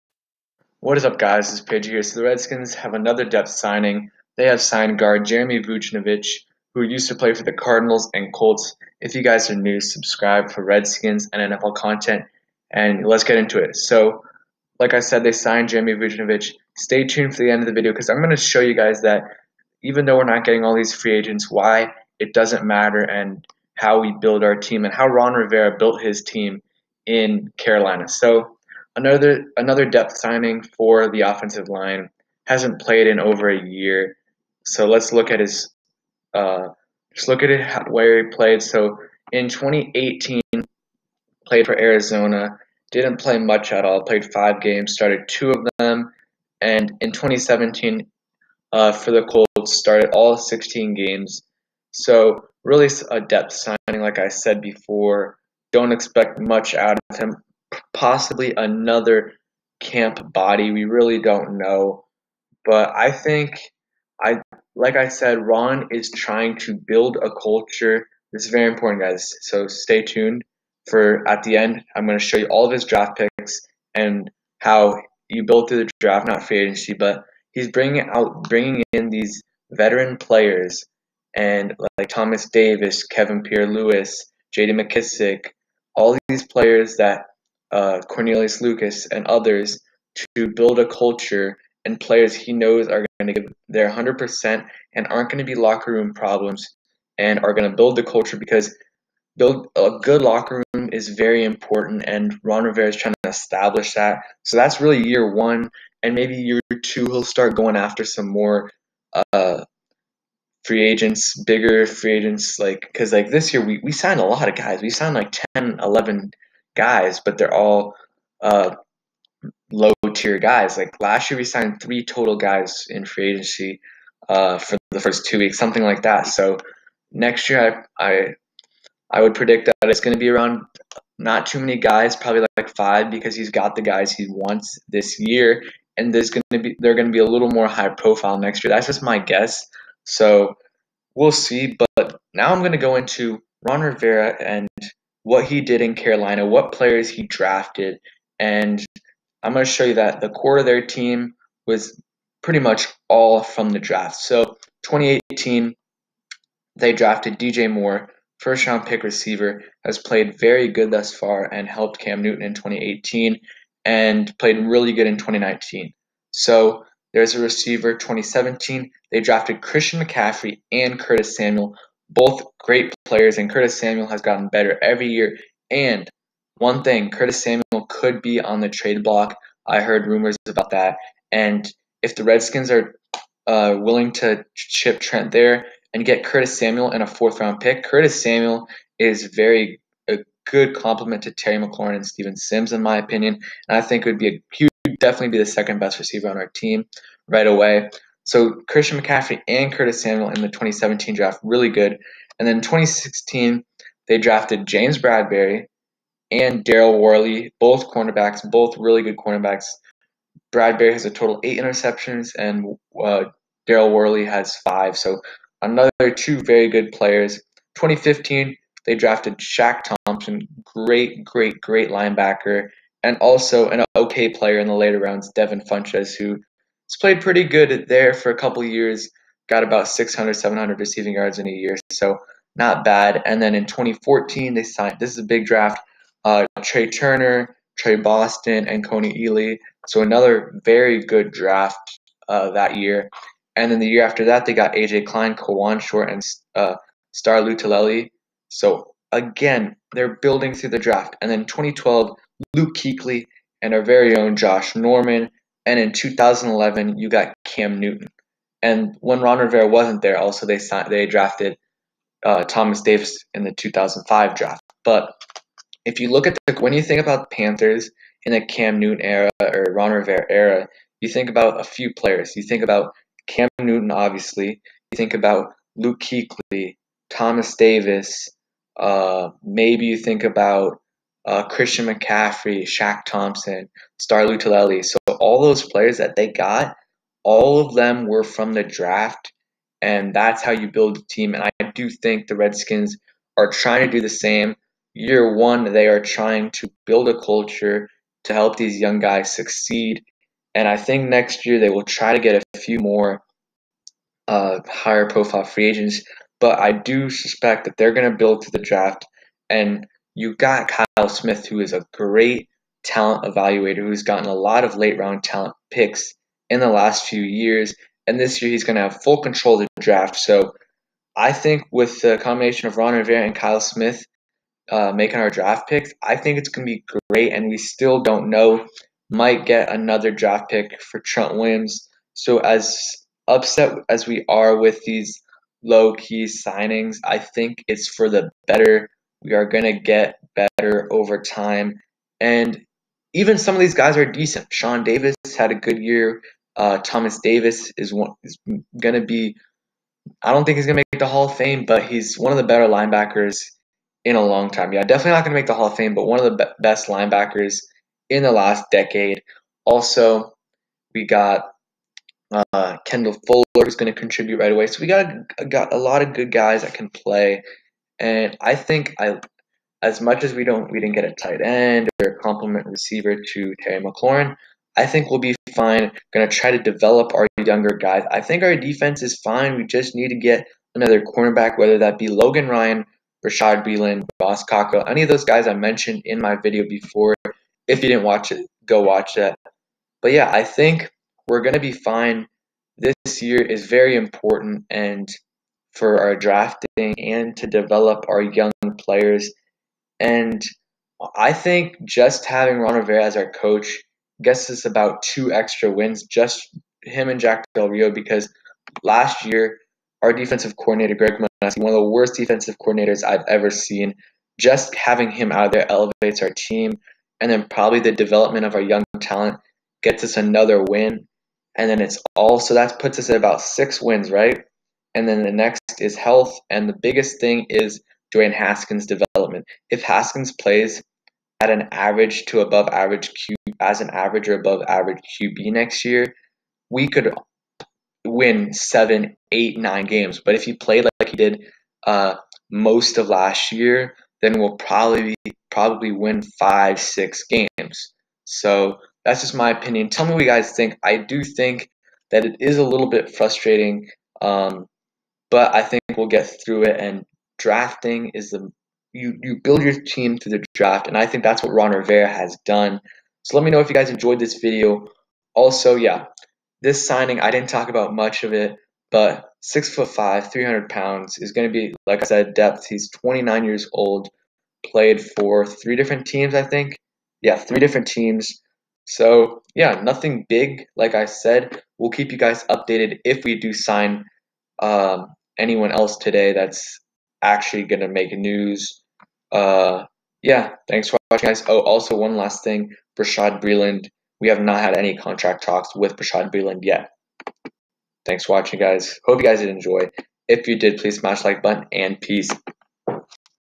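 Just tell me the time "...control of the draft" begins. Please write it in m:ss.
5:19.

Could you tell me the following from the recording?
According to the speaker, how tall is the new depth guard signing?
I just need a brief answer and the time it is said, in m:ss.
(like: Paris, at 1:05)
6 foot 5, at 7:49.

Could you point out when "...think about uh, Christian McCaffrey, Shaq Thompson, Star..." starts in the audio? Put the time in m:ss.
4:39.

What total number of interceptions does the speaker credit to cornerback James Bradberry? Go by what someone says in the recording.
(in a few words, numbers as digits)
8.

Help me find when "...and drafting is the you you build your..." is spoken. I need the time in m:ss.
7:36.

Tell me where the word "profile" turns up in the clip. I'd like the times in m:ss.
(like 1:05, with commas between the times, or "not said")
2:17, 5:05.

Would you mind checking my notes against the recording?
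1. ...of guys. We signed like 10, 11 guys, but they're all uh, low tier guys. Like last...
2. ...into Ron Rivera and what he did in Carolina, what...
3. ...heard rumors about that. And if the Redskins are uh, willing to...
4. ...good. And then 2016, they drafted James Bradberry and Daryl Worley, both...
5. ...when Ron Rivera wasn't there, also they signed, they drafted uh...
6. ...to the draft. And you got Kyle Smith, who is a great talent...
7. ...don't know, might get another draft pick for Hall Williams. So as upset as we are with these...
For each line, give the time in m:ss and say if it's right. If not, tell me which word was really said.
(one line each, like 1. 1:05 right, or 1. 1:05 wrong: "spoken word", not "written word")
1. 1:54 right
2. 2:22 right
3. 2:59 right
4. 3:21 right
5. 4:18 right
6. 5:08 right
7. 5:28 wrong: "Trent", not "Hall".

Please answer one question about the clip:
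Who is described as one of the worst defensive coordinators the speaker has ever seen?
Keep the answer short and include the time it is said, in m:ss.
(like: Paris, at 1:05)
Greg Manusky, at 6:50.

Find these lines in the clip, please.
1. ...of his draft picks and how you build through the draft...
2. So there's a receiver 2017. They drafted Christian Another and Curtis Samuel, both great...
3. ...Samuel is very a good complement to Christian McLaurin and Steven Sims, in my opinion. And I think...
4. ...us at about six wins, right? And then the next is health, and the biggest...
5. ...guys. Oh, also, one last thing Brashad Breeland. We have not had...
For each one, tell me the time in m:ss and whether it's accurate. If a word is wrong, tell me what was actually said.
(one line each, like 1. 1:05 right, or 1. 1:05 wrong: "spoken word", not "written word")
1. 1:12 right
2. 2:46 wrong: "McCaffrey", not "Another"
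3. 3:08 wrong: "Terry", not "Christian"
4. 7:02 right
5. 8:11 right.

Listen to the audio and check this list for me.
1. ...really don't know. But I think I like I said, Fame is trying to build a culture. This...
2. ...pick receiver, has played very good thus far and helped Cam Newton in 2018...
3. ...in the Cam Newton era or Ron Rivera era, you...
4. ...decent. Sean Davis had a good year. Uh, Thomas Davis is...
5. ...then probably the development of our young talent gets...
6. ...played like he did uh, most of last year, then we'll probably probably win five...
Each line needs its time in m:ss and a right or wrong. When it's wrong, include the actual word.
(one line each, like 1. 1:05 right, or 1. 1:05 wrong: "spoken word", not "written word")
1. 1:00 wrong: "Ron", not "Fame"
2. 2:38 right
3. 4:28 right
4. 5:44 right
5. 6:57 right
6. 7:20 right.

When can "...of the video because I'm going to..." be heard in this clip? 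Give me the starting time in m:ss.
0:17.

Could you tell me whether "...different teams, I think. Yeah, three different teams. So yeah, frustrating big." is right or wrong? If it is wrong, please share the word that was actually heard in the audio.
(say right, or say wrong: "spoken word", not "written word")
wrong: "nothing", not "frustrating".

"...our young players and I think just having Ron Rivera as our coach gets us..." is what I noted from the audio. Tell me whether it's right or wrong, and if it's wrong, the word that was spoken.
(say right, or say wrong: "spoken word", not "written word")
right.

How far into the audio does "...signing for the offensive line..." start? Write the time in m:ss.
0:30.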